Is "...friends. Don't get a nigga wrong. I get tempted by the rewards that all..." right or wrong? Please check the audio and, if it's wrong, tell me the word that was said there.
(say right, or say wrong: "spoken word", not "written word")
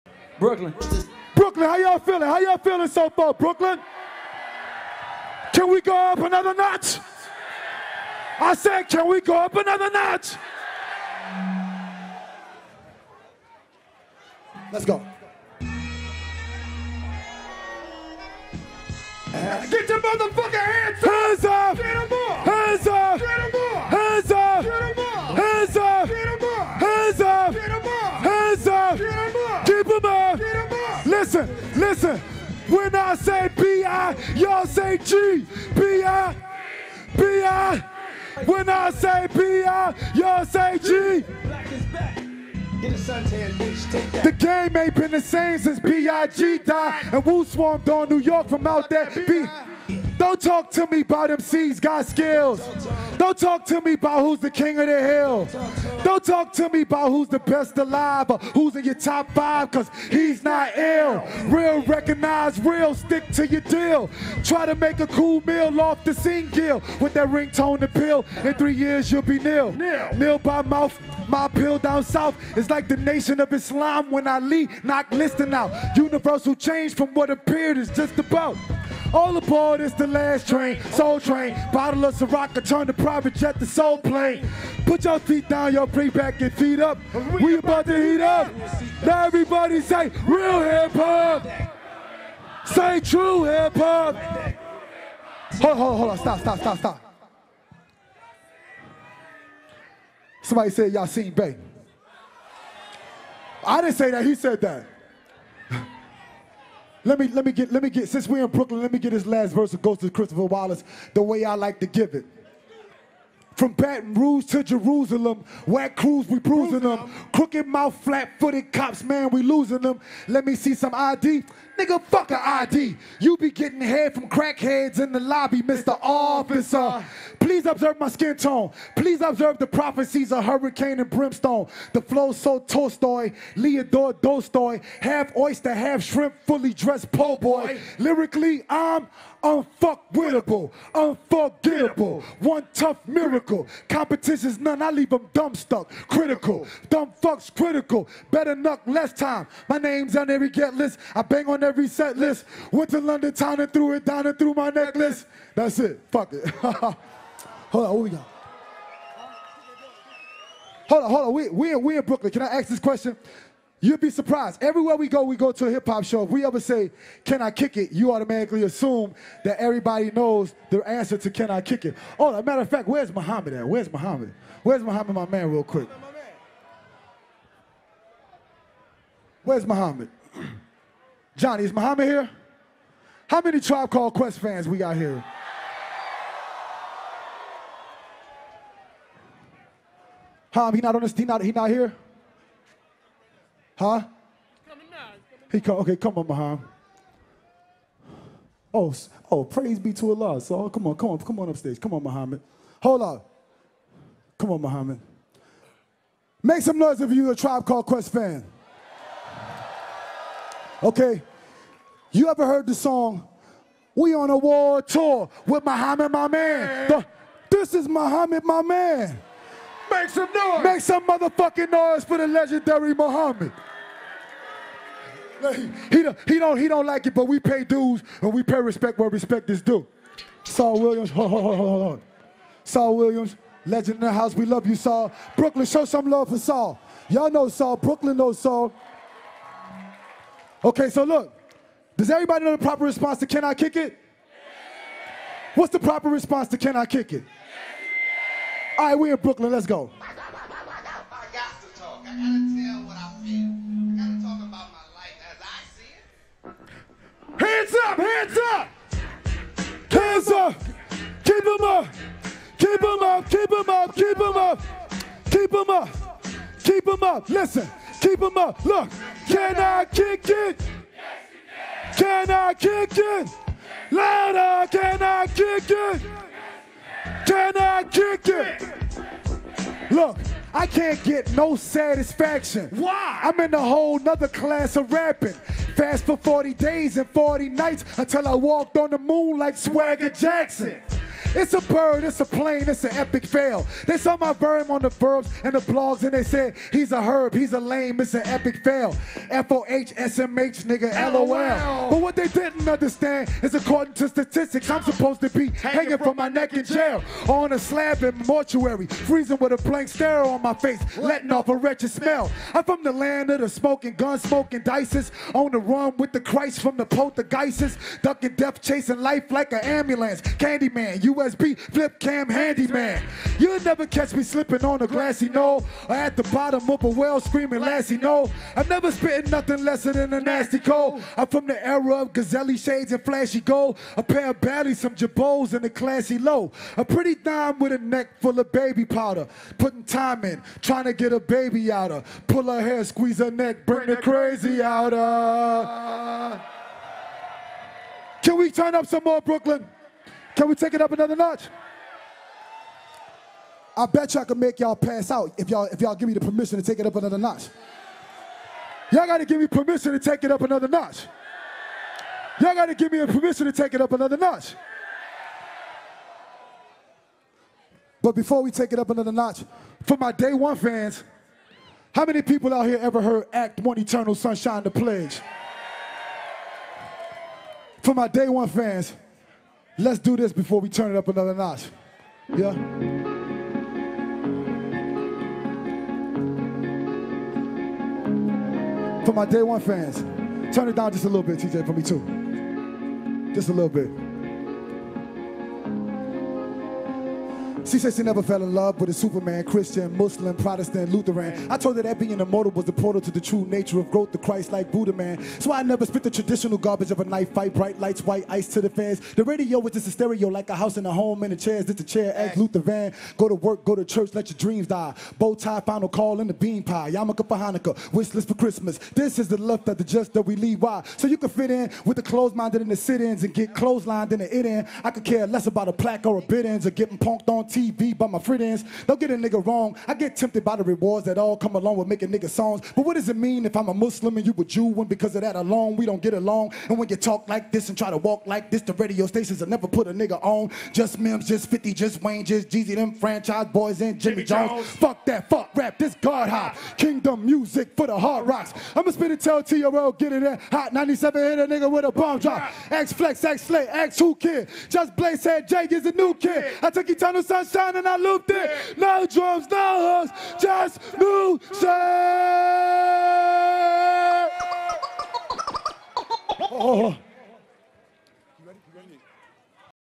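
right.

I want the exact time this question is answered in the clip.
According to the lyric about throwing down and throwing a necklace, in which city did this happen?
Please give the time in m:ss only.
2:32.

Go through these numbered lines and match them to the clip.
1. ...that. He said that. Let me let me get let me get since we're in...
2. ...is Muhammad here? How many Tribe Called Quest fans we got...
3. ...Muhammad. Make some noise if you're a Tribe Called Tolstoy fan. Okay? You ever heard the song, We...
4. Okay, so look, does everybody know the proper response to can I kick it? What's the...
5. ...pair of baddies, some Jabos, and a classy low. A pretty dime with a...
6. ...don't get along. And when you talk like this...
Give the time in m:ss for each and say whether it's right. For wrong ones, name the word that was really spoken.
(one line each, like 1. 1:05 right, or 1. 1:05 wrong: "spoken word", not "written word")
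1. 1:44 right
2. 3:01 right
3. 3:24 wrong: "Quest", not "Tolstoy"
4. 4:00 right
5. 5:34 right
6. 7:15 right.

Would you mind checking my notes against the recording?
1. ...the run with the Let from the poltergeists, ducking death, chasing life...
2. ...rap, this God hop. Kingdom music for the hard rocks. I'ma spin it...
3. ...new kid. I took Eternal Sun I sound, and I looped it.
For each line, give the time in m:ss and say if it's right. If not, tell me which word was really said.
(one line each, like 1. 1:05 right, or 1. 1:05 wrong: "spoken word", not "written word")
1. 5:15 wrong: "Christ", not "Let"
2. 7:25 right
3. 7:35 right.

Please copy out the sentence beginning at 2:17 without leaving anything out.
Lyrically, I'm unfuckwittable, unforgettable, one tough miracle.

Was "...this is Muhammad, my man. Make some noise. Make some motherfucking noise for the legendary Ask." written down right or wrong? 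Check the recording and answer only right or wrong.
wrong.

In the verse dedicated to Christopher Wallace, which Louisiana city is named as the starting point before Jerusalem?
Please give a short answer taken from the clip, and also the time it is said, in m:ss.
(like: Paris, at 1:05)
Baton Rouge, at 1:53.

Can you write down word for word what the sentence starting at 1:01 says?
Real, recognize real, stick to your deal.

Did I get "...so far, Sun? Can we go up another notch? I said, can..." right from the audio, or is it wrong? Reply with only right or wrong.
wrong.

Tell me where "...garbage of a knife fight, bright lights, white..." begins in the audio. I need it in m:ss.
6:46.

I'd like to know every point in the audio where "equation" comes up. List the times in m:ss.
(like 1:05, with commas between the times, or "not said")
not said.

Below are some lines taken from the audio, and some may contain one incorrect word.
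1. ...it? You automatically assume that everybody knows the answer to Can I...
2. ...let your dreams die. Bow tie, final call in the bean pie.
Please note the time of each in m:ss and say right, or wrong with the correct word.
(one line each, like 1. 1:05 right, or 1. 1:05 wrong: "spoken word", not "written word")
1. 2:47 right
2. 6:54 right.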